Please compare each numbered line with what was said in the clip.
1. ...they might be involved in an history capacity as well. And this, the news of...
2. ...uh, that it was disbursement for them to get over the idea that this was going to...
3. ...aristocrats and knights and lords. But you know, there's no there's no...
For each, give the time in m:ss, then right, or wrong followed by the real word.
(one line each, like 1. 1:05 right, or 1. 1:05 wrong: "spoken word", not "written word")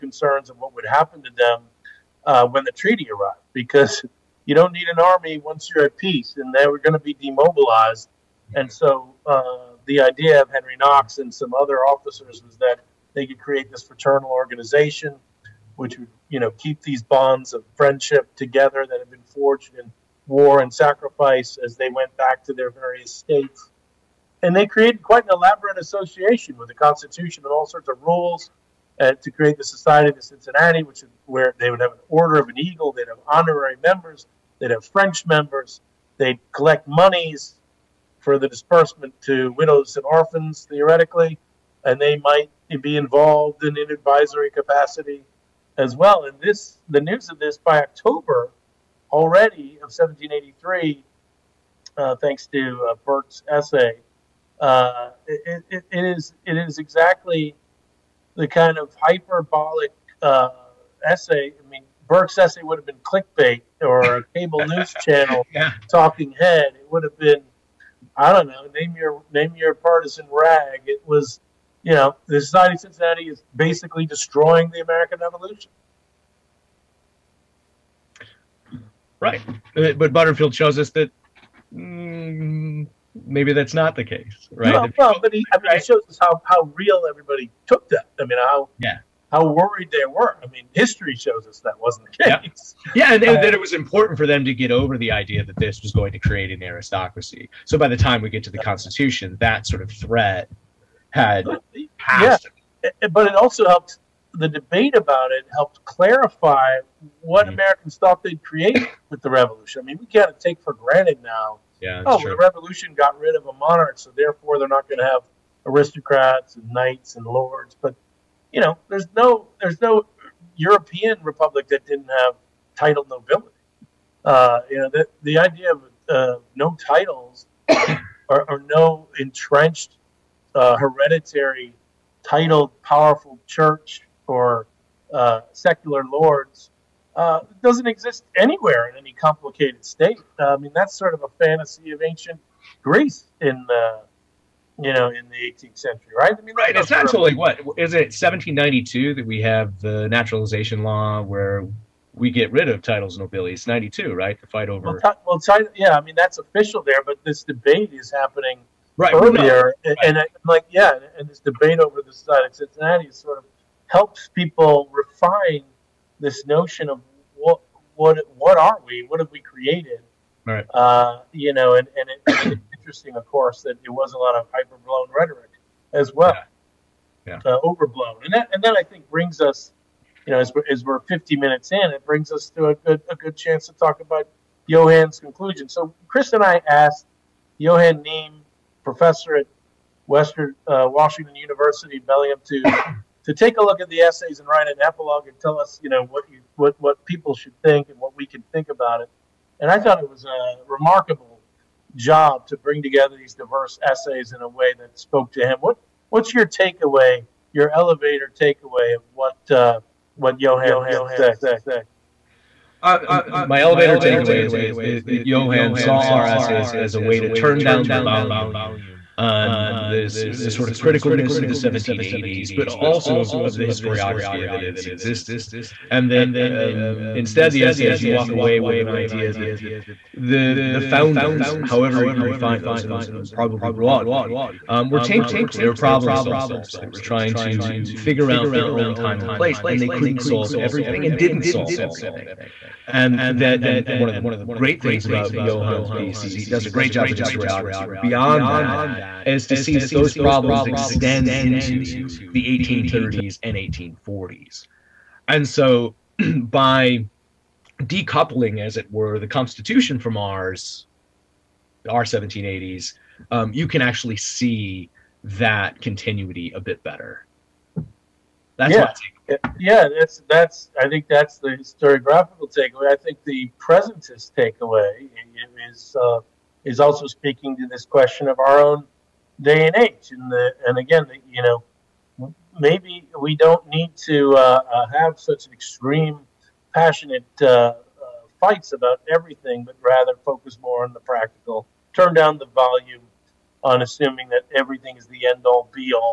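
1. 0:41 wrong: "advisory", not "history"
2. 1:33 wrong: "important", not "disbursement"
3. 1:55 right.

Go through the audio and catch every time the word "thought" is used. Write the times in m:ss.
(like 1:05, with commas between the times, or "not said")
1:47, 3:19.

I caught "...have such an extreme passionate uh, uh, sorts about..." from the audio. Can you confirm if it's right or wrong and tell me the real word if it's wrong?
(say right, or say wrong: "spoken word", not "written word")
wrong: "fights", not "sorts".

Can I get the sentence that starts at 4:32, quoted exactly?
I think the presentist takeaway is uh, is also speaking to this question of our own day and age.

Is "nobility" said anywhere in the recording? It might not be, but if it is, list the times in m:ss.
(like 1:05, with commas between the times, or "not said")
2:03, 2:33.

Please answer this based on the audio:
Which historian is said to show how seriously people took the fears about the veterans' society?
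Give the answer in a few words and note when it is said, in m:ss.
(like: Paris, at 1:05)
Butterfield, at 1:20.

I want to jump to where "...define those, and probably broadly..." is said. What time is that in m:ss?
3:52.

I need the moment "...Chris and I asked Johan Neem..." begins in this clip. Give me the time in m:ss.
3:06.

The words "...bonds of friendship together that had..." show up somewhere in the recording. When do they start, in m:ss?
0:17.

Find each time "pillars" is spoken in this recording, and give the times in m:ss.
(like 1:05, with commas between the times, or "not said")
not said.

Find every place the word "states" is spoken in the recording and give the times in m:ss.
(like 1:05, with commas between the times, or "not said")
0:23, 2:19.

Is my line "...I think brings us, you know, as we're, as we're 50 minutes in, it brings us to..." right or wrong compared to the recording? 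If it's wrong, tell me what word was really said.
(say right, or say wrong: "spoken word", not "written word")
right.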